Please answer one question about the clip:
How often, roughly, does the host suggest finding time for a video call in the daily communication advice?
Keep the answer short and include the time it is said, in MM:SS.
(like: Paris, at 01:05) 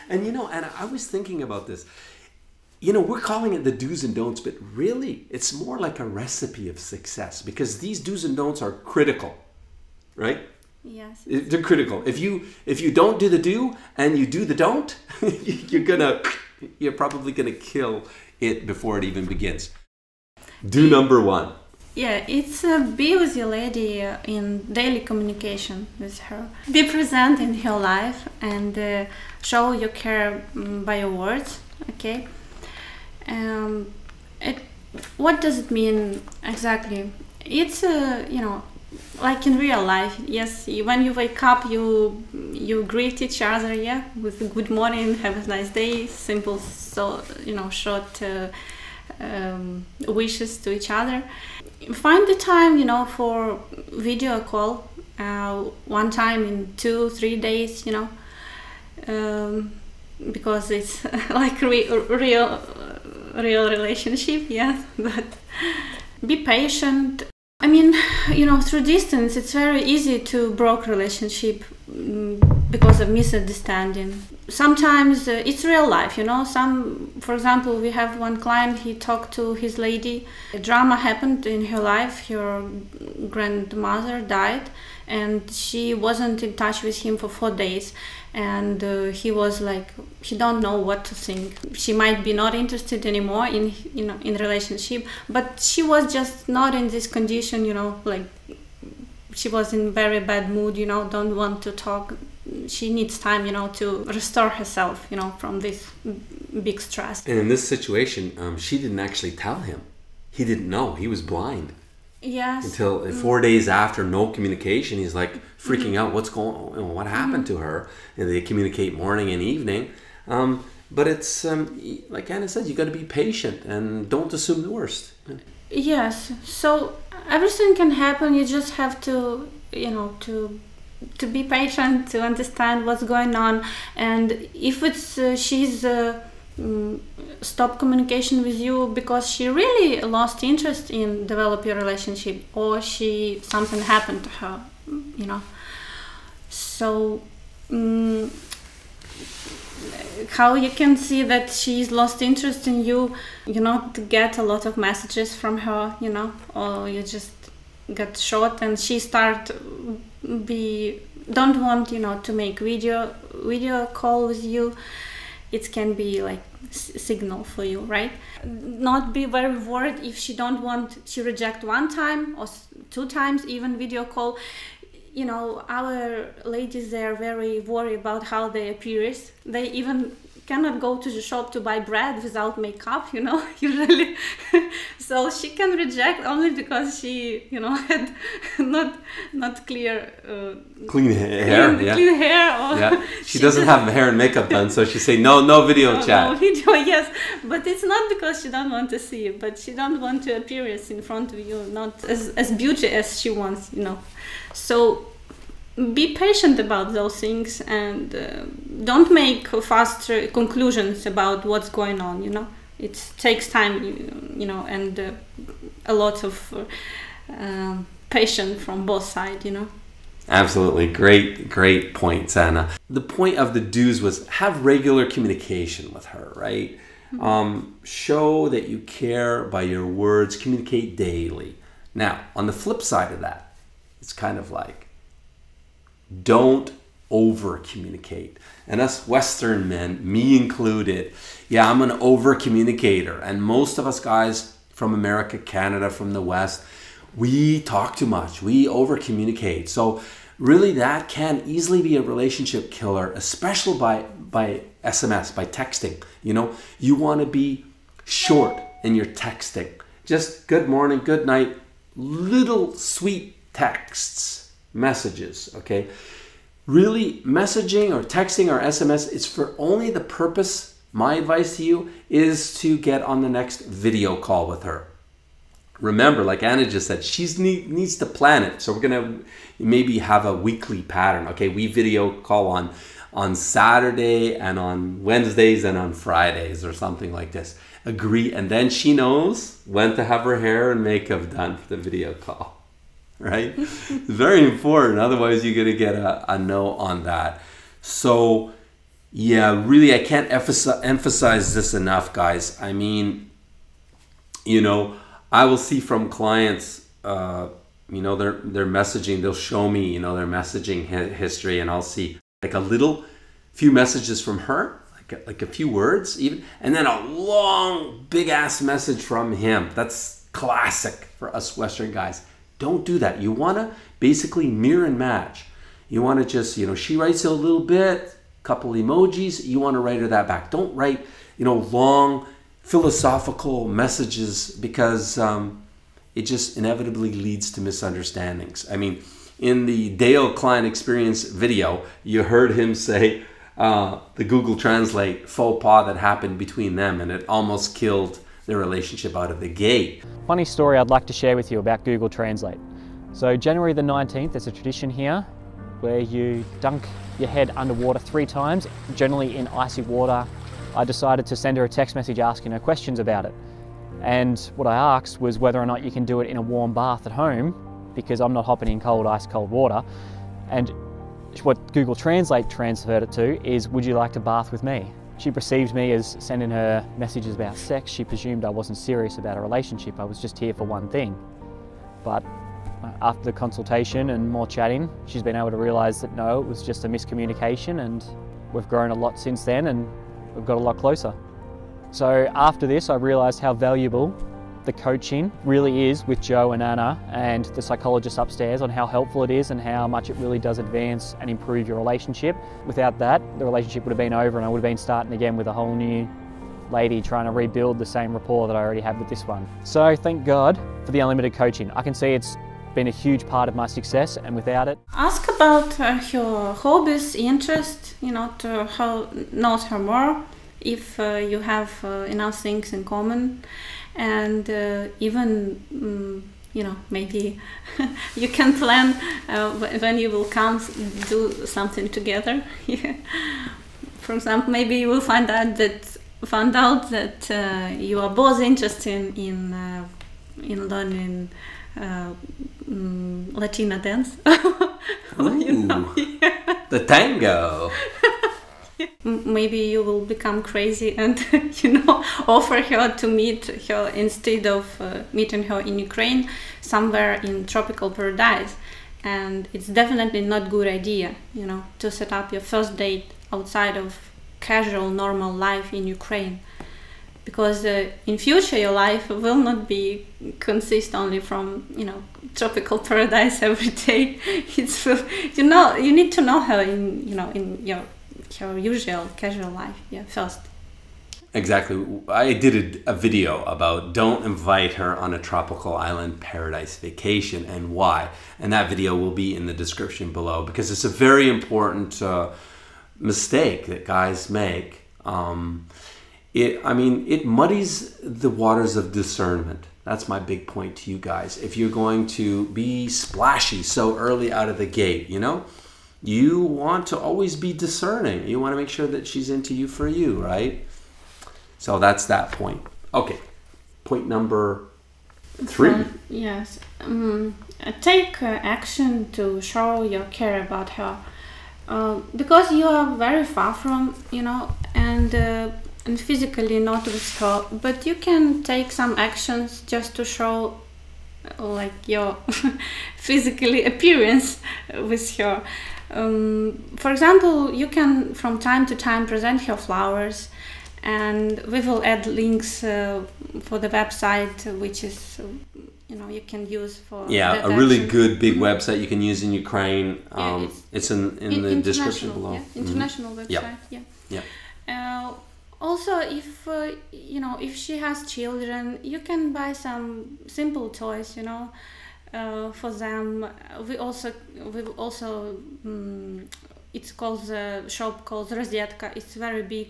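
Once in 2-3 days, at 00:55.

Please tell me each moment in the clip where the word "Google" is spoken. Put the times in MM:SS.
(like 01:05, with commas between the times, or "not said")
05:44, 05:51, 06:11.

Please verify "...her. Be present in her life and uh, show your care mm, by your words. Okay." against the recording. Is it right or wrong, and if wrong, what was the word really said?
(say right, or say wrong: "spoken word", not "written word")
right.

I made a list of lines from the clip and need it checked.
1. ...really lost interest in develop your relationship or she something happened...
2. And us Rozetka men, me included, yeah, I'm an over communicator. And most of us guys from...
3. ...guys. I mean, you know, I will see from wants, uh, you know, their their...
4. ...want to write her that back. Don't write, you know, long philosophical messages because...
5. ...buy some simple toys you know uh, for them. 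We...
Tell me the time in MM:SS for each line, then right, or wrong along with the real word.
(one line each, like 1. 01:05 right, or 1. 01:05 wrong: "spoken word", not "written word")
1. 02:19 right
2. 03:58 wrong: "Western", not "Rozetka"
3. 05:02 wrong: "clients", not "wants"
4. 05:29 right
5. 09:19 right.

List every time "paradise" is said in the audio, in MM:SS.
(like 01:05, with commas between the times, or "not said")
07:37, 07:52, 08:06.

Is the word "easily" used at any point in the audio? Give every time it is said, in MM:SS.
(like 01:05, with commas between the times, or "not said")
04:11.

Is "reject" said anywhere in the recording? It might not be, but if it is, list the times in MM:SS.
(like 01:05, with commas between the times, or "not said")
02:51, 03:05.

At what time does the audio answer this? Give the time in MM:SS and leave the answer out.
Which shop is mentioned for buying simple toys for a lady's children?
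09:28.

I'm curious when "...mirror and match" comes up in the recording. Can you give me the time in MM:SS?
05:24.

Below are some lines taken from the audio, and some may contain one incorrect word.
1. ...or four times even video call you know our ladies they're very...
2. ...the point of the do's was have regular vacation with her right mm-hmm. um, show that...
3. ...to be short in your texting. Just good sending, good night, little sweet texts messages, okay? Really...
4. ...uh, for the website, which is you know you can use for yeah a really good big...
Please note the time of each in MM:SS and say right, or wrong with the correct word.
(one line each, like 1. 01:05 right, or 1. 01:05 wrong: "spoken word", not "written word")
1. 02:52 wrong: "two", not "four"
2. 03:42 wrong: "communication", not "vacation"
3. 04:17 wrong: "morning", not "sending"
4. 09:02 right.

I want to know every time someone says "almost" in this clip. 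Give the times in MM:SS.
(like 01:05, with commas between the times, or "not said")
05:47.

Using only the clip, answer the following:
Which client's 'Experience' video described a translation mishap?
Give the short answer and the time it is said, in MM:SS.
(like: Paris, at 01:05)
Dale Klein, at 05:39.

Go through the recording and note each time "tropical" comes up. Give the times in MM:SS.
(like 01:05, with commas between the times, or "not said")
07:37, 07:52, 08:05.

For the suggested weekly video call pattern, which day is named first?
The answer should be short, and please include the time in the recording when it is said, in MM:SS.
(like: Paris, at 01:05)
Saturday, at 04:43.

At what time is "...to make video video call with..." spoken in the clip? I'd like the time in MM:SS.
02:42.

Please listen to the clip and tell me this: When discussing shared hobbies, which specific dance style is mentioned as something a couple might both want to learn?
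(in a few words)
Tango.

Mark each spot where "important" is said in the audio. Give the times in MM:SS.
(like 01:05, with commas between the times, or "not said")
04:54, 08:11.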